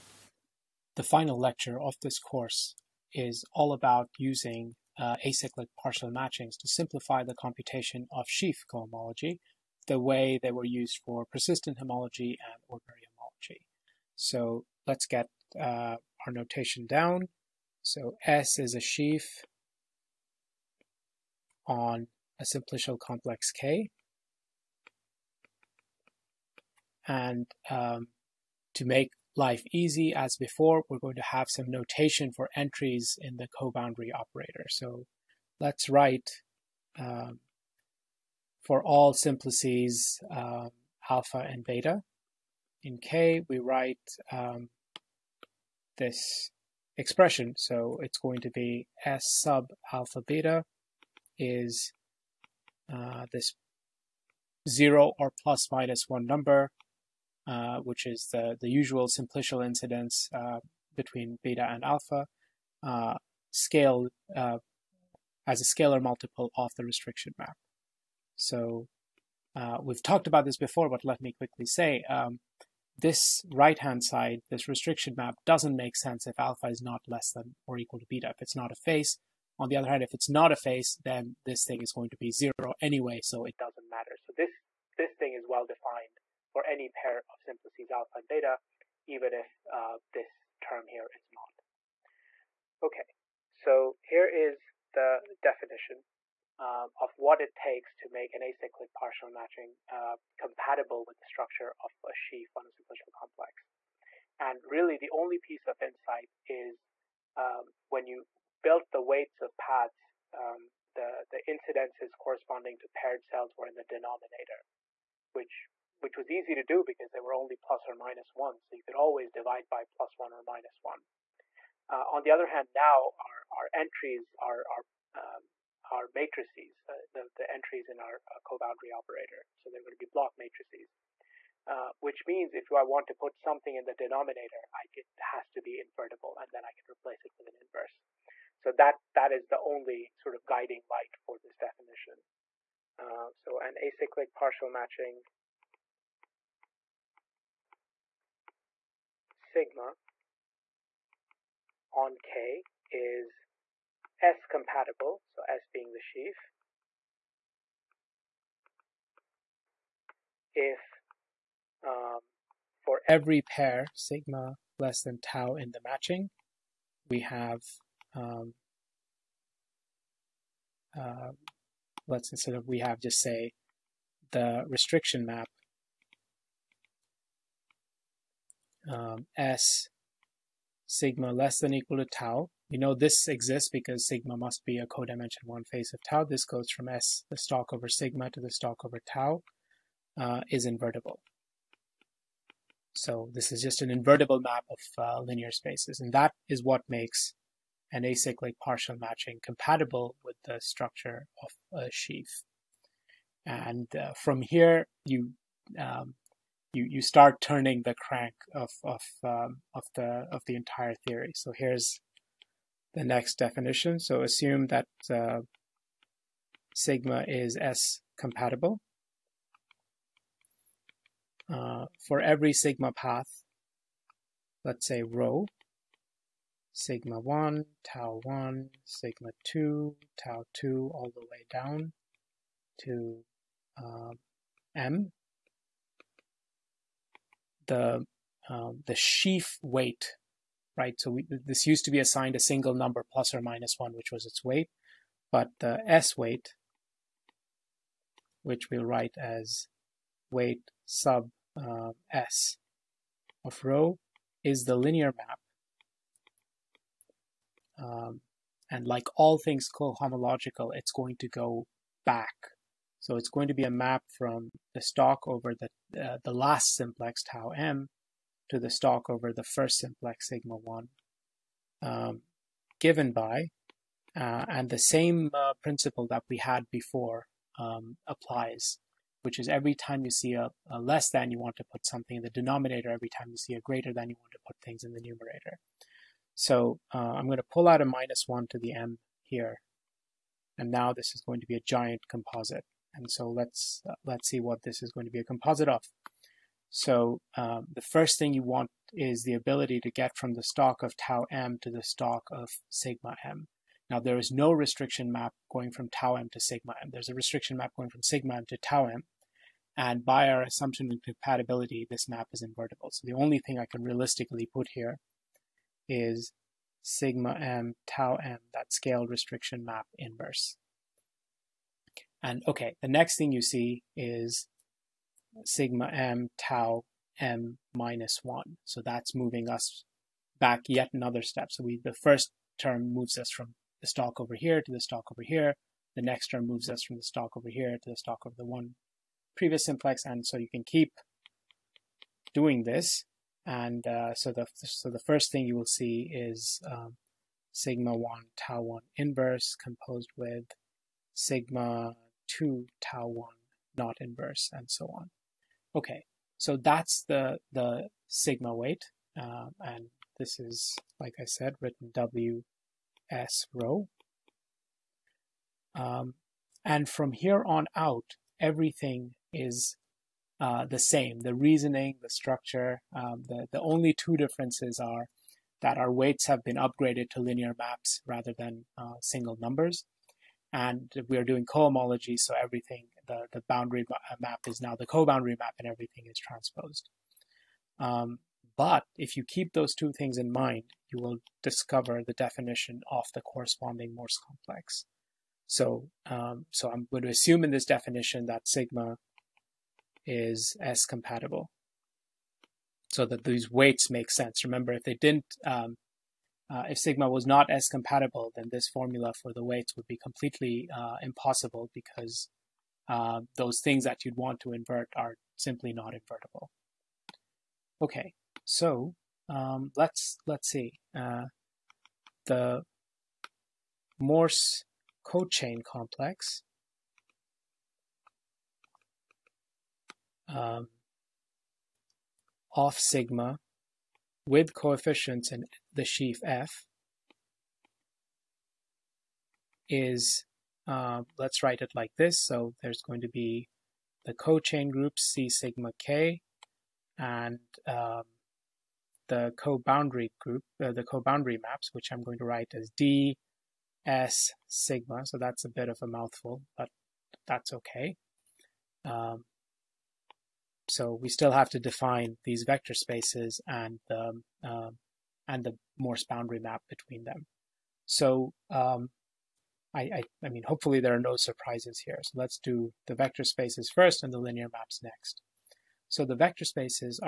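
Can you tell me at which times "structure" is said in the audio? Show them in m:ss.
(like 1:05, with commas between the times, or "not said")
1:41, 3:20, 6:12.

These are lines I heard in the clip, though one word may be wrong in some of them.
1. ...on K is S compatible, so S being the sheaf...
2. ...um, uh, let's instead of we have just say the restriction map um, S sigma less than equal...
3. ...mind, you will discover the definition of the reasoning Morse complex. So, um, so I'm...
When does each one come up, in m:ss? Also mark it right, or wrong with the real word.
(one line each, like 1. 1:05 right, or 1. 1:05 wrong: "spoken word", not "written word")
1. 2:31 right
2. 2:48 right
3. 6:30 wrong: "corresponding", not "reasoning".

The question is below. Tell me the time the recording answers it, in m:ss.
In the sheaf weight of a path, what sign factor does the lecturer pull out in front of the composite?
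4:47.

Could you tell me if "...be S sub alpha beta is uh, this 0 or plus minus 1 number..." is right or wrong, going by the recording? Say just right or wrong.
right.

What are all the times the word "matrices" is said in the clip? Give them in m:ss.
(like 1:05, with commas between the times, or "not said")
2:06, 2:10.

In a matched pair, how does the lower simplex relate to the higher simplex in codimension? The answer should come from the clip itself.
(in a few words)
Codimension one face.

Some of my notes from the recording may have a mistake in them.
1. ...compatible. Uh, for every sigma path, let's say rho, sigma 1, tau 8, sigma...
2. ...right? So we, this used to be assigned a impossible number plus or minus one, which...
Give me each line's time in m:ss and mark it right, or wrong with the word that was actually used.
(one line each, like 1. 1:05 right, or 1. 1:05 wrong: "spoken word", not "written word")
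1. 3:38 wrong: "1", not "8"
2. 4:00 wrong: "single", not "impossible".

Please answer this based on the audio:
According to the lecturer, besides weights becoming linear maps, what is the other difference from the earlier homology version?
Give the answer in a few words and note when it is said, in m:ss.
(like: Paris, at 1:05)
Everything is transposed, at 6:25.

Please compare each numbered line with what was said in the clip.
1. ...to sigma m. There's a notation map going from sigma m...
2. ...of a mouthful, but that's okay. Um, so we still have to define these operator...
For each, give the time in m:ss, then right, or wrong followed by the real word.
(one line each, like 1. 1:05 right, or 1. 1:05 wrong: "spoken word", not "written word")
1. 5:06 wrong: "restriction", not "notation"
2. 7:35 wrong: "vector", not "operator".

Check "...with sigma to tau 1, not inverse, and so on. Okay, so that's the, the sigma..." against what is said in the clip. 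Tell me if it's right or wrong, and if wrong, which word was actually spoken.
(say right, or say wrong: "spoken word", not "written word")
right.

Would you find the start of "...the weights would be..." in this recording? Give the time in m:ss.
6:49.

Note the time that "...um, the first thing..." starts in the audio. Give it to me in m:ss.
4:57.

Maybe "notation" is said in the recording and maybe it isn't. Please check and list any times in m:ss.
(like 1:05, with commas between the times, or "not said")
0:16, 0:31.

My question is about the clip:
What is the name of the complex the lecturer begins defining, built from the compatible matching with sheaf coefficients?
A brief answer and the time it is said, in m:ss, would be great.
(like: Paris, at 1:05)
Morse cochain complex, at 7:03.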